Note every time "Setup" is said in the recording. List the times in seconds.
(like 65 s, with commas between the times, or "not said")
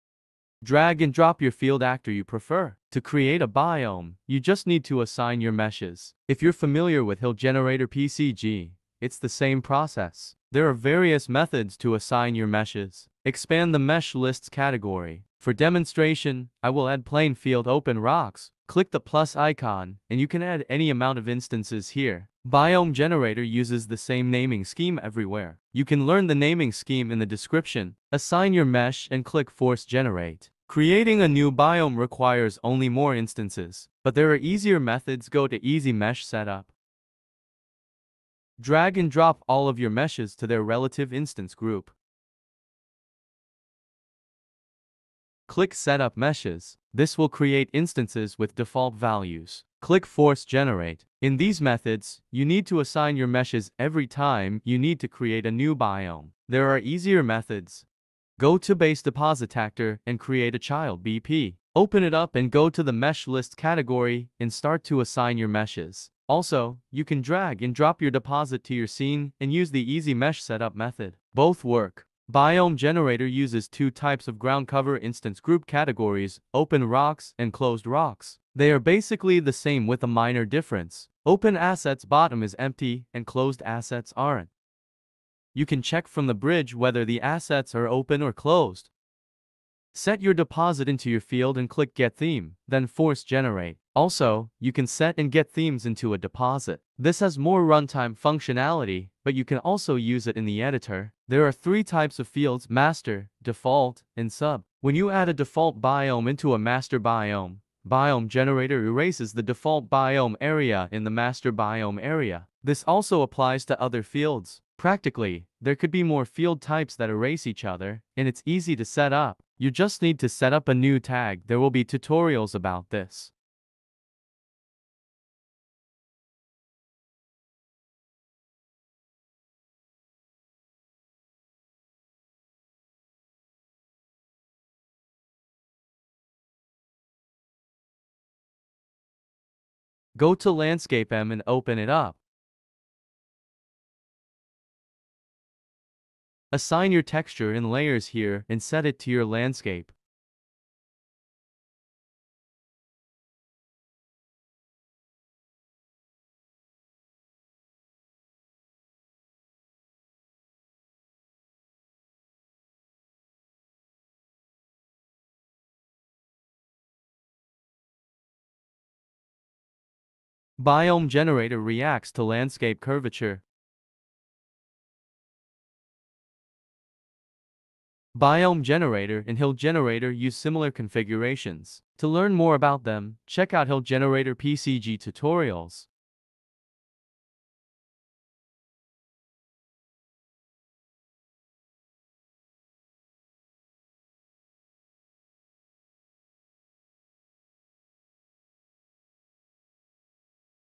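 36 s, 45 s, 70 s.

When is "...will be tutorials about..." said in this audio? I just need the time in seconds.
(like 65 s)
121 s.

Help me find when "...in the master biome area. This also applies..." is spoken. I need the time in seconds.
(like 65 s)
110 s.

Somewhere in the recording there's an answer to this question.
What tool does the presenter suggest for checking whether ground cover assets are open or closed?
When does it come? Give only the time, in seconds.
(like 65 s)
86 s.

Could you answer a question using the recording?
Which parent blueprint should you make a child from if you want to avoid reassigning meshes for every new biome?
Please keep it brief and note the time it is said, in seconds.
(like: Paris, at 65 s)
Base Deposit Actor, at 58 s.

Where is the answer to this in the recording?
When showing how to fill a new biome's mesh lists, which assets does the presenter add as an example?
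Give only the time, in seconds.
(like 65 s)
17 s.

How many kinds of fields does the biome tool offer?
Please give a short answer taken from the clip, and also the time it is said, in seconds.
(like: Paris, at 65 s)
3, at 101 s.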